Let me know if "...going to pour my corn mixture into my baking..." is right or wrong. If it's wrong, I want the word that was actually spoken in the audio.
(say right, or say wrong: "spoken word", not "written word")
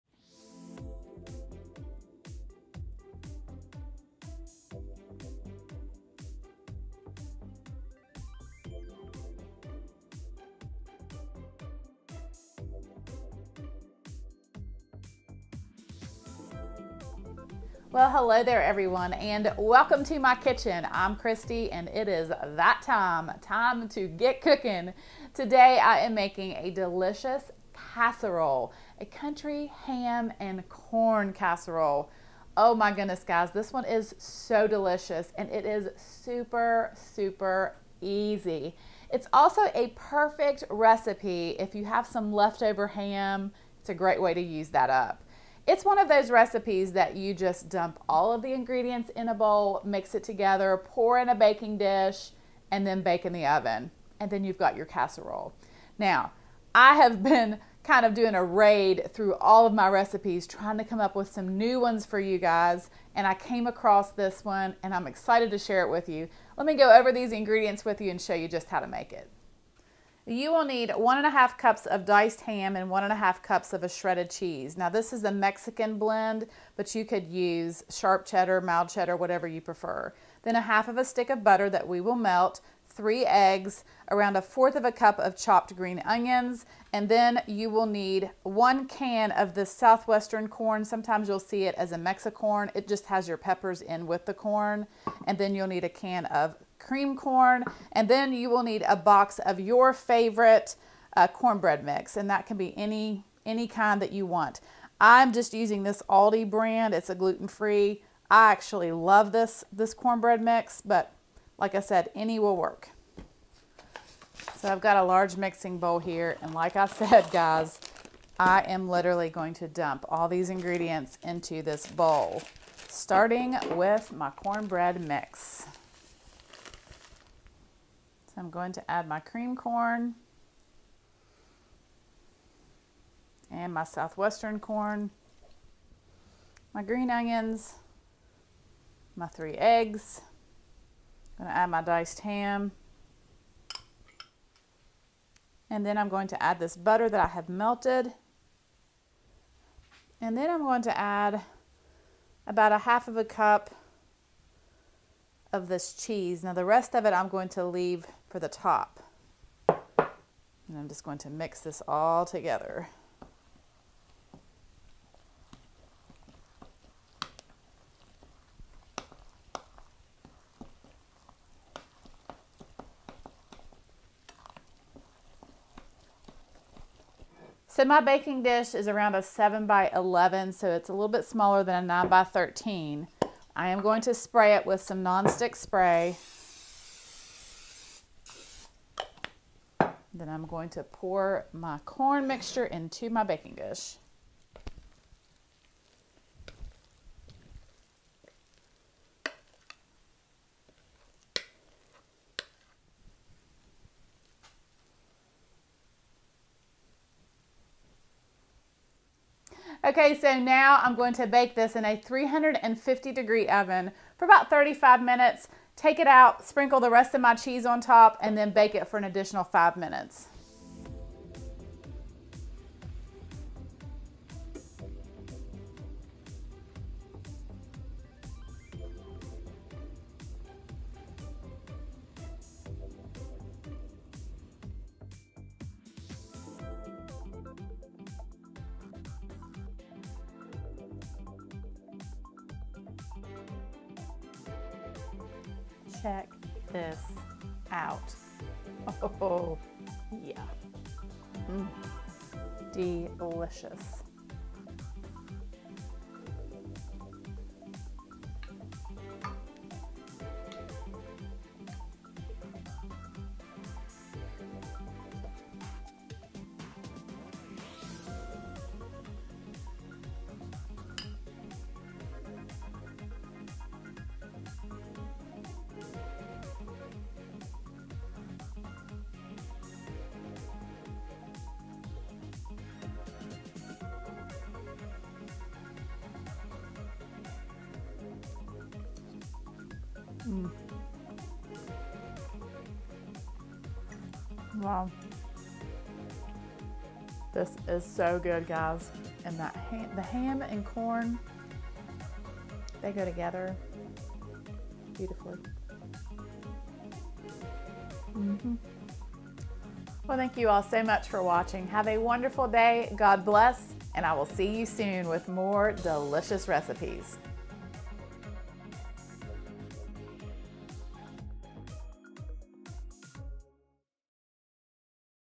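right.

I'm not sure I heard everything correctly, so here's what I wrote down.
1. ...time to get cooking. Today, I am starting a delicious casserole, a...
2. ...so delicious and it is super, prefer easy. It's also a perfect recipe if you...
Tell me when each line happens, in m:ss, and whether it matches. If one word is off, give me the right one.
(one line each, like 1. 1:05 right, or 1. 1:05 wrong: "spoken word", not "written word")
1. 0:23 wrong: "making", not "starting"
2. 0:34 wrong: "super", not "prefer".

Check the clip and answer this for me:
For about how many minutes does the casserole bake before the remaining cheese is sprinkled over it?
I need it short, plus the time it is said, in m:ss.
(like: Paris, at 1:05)
35 minutes, at 3:34.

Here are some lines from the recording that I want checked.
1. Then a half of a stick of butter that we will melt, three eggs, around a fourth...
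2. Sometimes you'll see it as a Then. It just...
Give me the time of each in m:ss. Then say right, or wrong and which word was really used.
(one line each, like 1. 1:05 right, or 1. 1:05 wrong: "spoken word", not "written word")
1. 1:20 right
2. 1:30 wrong: "Mexicorn", not "Then".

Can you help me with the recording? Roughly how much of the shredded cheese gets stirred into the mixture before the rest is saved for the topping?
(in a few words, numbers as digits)
1/2 cup.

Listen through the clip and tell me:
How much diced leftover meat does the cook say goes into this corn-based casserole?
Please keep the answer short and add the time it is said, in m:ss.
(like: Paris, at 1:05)
1 1/2 cups, at 1:10.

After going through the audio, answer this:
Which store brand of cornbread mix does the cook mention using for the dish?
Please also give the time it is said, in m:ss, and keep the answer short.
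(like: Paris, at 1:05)
Aldi, at 1:46.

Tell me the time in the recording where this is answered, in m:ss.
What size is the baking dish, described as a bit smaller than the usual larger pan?
2:59.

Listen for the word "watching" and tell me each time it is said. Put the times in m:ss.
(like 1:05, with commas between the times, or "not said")
5:11.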